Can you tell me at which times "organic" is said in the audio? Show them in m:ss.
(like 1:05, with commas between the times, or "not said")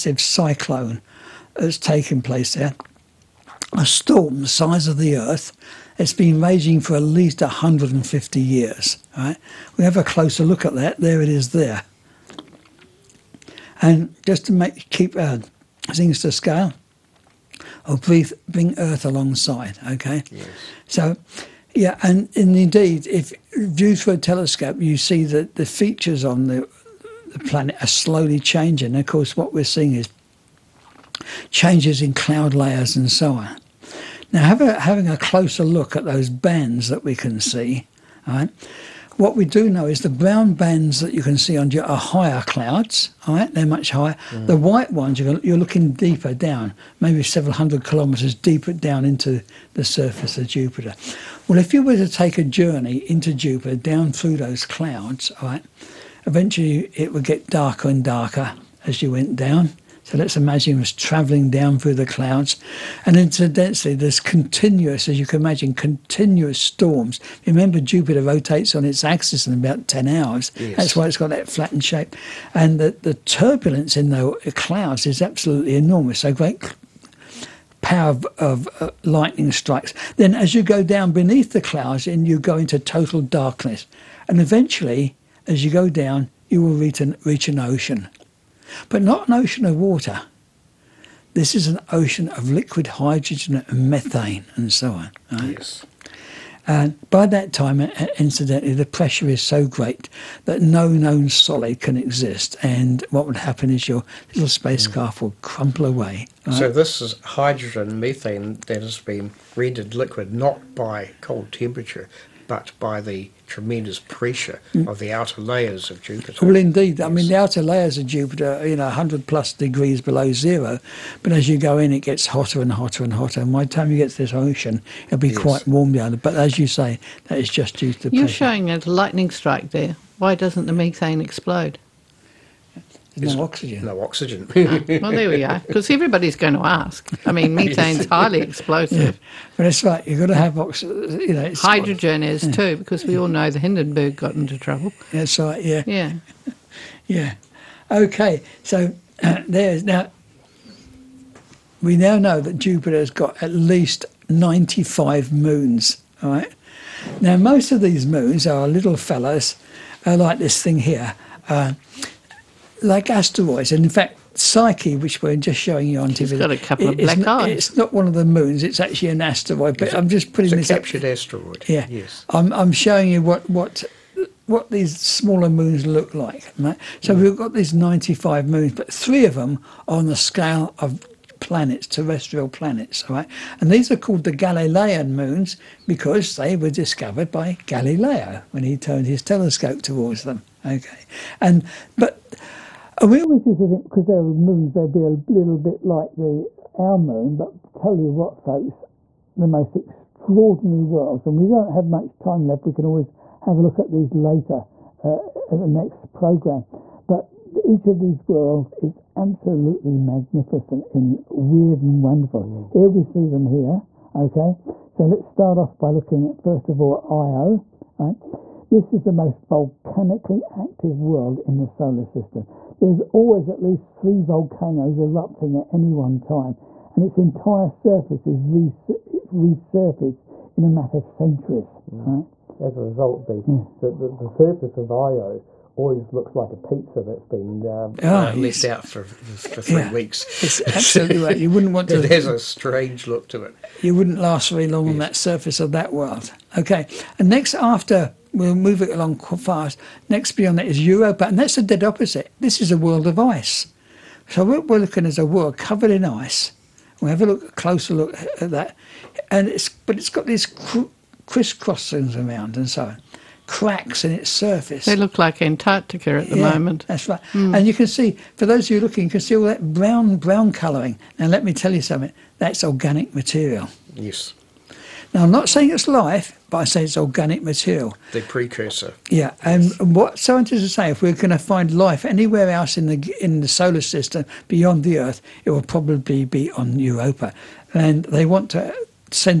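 4:32, 4:36.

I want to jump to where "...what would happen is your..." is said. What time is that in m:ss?
1:43.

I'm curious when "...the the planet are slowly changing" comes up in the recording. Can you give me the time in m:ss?
0:26.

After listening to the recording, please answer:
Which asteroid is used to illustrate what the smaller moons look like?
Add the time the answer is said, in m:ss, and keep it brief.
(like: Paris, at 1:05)
Psyche, at 2:44.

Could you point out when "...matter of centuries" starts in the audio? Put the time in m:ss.
3:50.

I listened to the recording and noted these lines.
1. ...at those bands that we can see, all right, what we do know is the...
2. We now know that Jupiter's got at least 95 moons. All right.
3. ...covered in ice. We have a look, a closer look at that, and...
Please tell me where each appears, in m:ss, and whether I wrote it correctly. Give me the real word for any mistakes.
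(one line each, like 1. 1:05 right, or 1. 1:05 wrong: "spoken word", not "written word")
1. 0:35 right
2. 2:31 right
3. 4:15 right.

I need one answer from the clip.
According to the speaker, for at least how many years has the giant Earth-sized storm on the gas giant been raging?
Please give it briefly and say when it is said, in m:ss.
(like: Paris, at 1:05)
150 years, at 0:07.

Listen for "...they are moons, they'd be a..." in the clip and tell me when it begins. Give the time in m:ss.
3:14.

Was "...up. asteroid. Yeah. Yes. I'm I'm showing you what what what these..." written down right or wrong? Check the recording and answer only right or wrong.
right.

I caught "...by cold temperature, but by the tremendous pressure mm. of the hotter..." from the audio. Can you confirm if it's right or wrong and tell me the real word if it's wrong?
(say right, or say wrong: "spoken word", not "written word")
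wrong: "outer", not "hotter".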